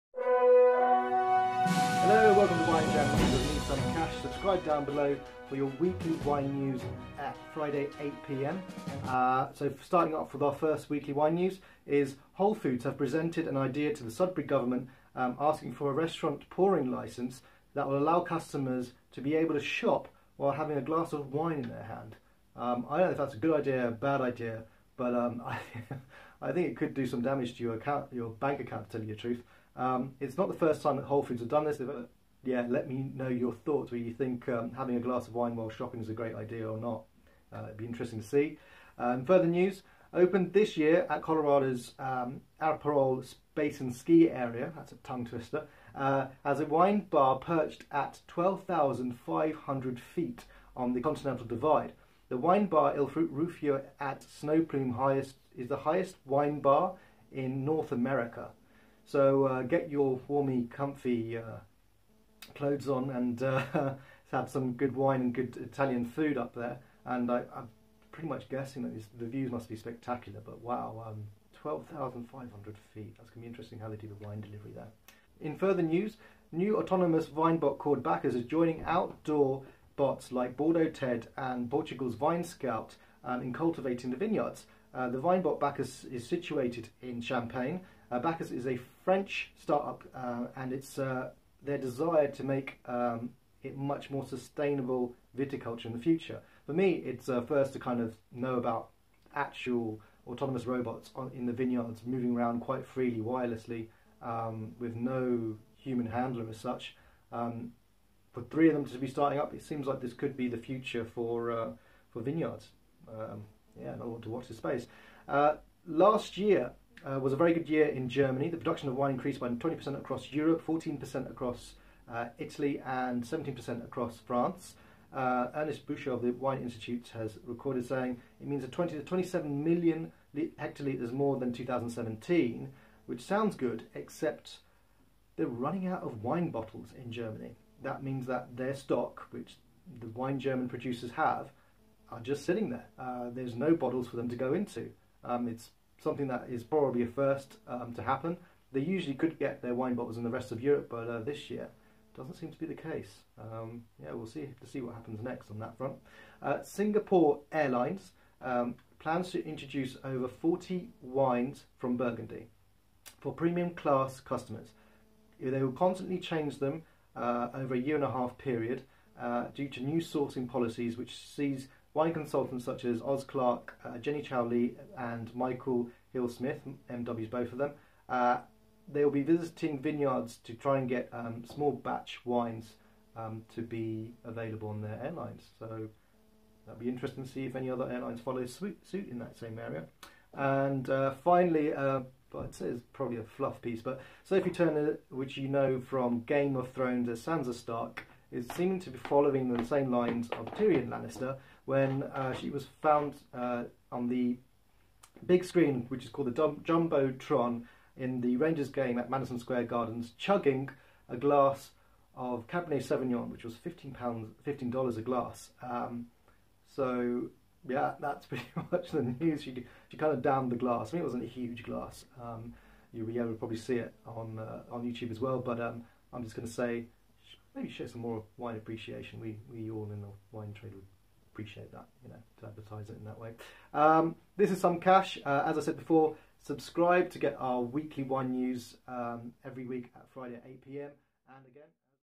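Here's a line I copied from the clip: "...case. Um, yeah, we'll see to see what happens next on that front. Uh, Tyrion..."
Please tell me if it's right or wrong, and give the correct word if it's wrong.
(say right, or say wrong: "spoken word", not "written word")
wrong: "Singapore", not "Tyrion".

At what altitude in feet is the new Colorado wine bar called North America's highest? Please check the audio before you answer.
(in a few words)
12,500 feet.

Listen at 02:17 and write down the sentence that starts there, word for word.
That means that their stock, which the wine German producers have, are just sitting there.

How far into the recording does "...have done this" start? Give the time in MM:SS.
00:31.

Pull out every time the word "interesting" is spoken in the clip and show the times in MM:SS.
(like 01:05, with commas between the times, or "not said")
00:37, 01:13, 03:06.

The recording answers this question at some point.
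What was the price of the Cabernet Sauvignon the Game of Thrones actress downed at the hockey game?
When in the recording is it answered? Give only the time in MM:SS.
03:34.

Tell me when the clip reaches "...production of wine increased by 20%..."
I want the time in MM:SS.
01:58.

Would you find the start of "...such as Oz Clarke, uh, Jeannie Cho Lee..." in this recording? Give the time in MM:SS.
02:52.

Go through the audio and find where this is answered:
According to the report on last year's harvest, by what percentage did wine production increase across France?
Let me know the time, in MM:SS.
02:03.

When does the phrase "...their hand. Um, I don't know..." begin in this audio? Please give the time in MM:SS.
00:21.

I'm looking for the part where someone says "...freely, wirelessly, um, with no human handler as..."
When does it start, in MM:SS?
01:42.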